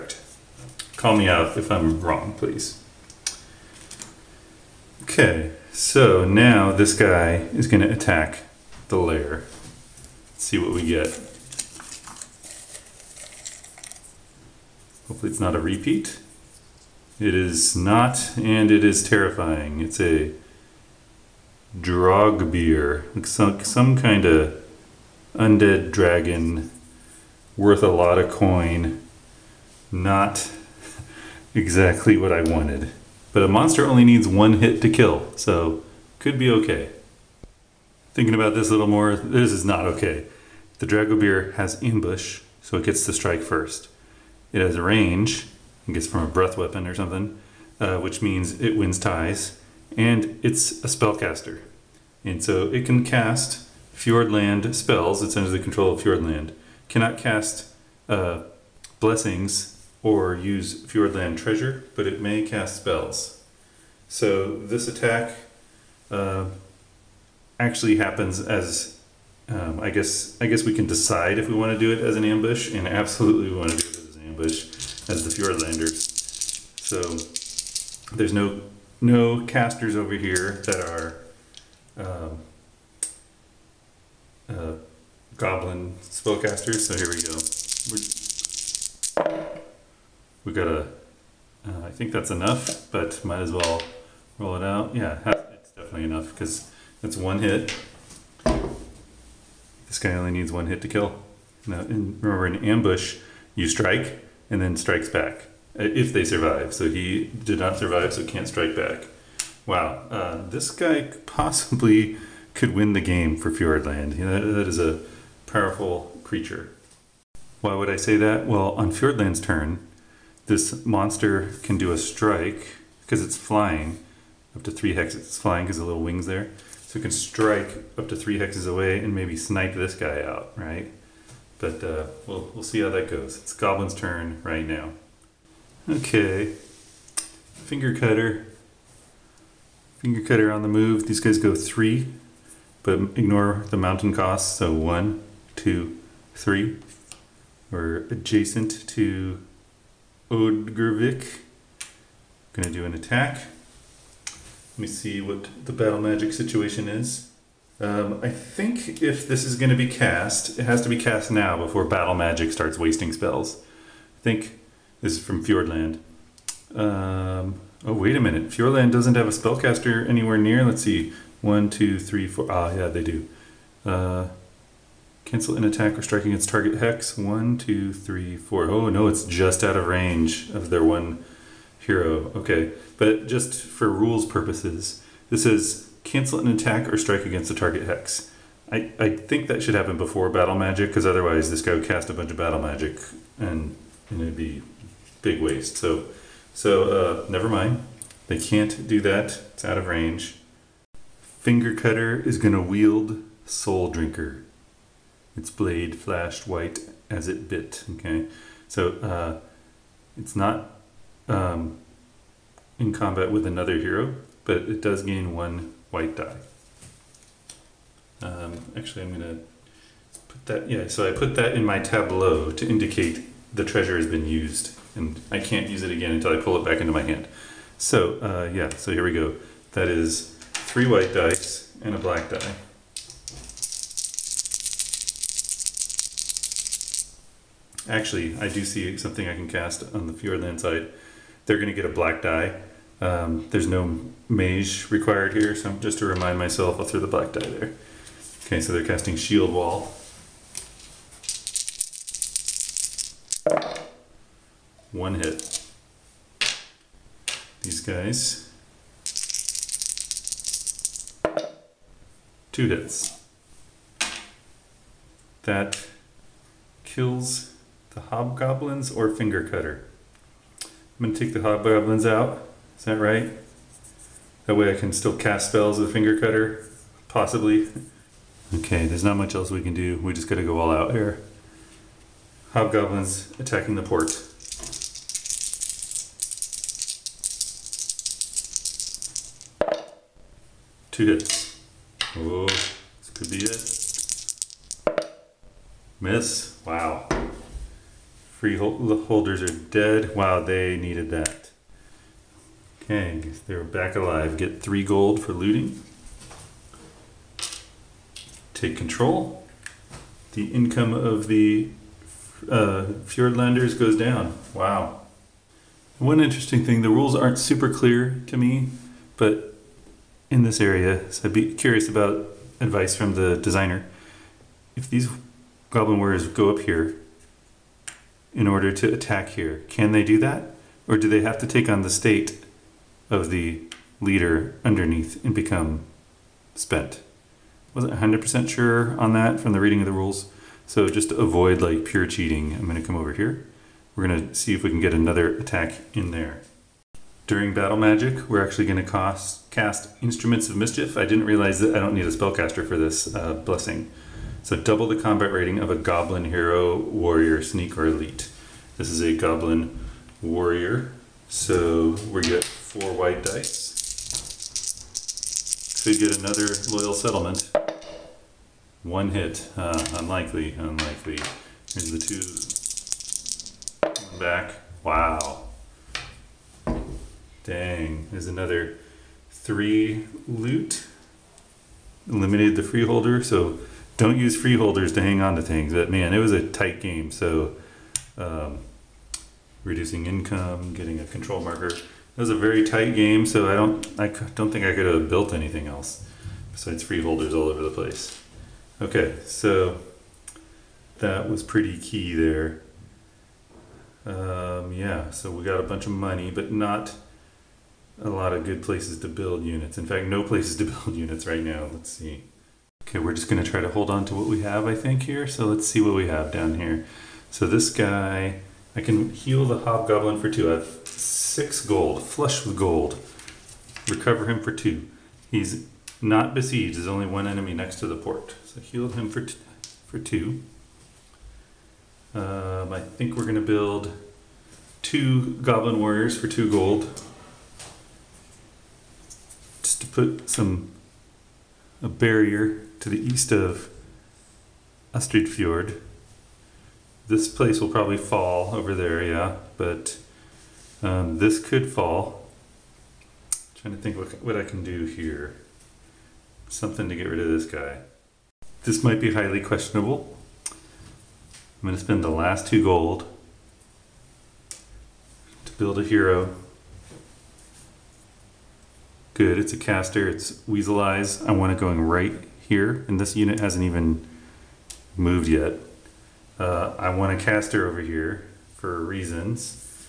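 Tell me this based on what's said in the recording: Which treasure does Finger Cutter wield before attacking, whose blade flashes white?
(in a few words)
Soul Drinker.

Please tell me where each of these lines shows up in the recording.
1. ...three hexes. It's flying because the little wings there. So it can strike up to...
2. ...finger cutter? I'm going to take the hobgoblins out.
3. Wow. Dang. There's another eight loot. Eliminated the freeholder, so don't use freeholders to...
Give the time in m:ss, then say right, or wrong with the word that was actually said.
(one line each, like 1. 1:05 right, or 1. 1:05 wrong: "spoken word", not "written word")
1. 2:04 right
2. 4:29 right
3. 6:14 wrong: "three", not "eight".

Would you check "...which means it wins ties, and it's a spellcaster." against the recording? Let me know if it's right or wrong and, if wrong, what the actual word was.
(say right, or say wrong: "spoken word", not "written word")
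right.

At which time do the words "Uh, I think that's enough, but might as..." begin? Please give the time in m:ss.
1:31.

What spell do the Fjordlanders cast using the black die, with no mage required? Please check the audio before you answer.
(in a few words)
Shield Wall.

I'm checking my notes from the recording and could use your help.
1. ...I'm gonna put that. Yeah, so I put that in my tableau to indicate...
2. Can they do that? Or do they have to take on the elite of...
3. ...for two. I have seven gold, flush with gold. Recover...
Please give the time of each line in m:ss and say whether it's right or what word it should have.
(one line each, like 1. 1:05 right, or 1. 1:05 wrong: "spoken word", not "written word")
1. 3:39 right
2. 5:29 wrong: "state", not "elite"
3. 7:00 wrong: "six", not "seven".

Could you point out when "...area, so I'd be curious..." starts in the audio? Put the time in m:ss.
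5:20.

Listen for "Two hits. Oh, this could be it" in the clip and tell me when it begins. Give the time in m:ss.
4:50.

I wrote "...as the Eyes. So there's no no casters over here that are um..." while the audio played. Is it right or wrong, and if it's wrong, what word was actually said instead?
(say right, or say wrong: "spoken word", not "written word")
wrong: "Fjordlanders", not "Eyes".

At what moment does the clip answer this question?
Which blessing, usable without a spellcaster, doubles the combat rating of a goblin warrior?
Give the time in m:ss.
5:50.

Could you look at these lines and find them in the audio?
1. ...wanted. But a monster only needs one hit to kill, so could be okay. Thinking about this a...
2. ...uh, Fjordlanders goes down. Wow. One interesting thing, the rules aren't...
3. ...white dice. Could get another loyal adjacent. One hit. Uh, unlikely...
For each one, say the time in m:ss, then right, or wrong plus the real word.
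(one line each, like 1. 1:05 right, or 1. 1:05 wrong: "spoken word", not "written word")
1. 0:32 right
2. 5:12 right
3. 6:02 wrong: "settlement", not "adjacent".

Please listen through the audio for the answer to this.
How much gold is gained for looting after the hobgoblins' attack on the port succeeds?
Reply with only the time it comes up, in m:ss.
5:04.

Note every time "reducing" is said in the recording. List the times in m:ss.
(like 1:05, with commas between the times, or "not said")
6:29.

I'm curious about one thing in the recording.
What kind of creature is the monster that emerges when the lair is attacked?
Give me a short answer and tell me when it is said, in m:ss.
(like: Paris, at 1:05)
Undead dragon, at 0:25.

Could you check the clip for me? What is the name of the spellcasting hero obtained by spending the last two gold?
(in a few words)
Weasel Eyes.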